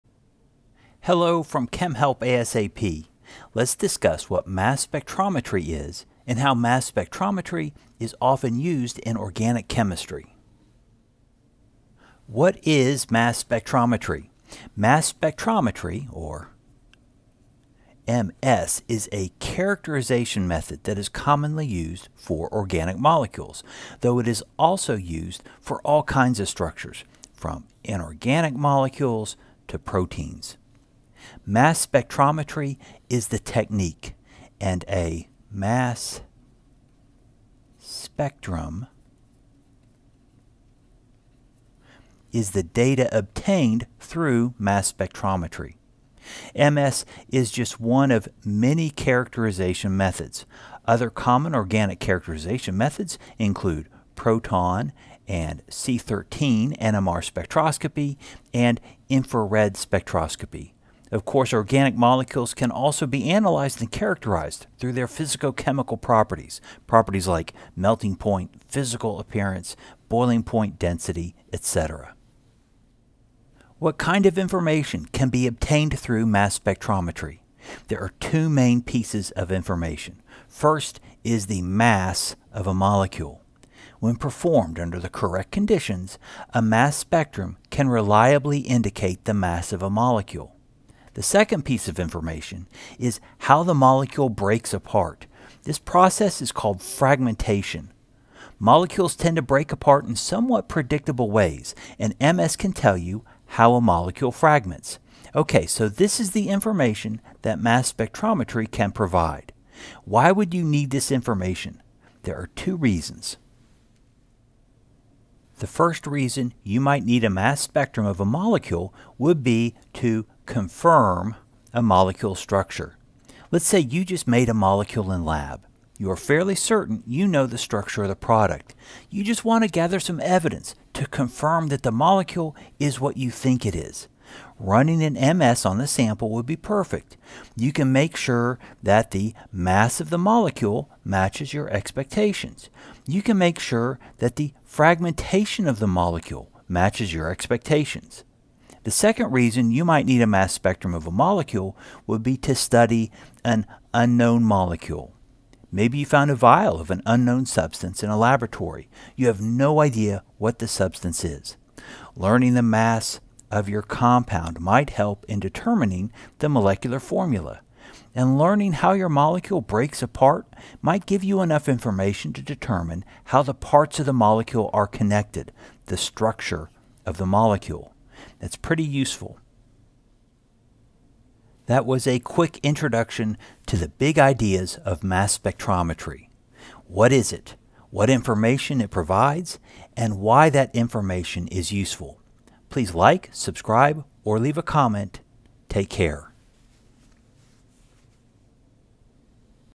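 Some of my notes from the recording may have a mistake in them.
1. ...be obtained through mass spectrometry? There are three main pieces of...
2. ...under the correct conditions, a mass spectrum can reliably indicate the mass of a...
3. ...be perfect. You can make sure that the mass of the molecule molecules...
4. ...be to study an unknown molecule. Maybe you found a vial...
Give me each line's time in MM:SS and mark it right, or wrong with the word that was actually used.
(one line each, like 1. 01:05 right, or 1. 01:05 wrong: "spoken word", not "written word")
1. 01:15 wrong: "two", not "three"
2. 01:24 right
3. 02:16 wrong: "matches", not "molecules"
4. 02:32 right.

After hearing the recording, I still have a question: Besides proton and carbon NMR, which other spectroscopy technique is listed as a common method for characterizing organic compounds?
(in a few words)
Infrared spectroscopy.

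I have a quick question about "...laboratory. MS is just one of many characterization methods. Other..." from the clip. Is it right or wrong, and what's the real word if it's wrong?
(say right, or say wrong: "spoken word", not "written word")
wrong: "spectrometry", not "laboratory".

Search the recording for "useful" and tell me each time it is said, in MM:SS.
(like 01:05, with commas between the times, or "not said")
02:58, 03:11.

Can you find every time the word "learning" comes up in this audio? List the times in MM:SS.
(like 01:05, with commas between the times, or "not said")
02:42, 02:48.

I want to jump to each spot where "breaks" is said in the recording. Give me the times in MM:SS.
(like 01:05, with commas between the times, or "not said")
01:34, 01:39, 02:49.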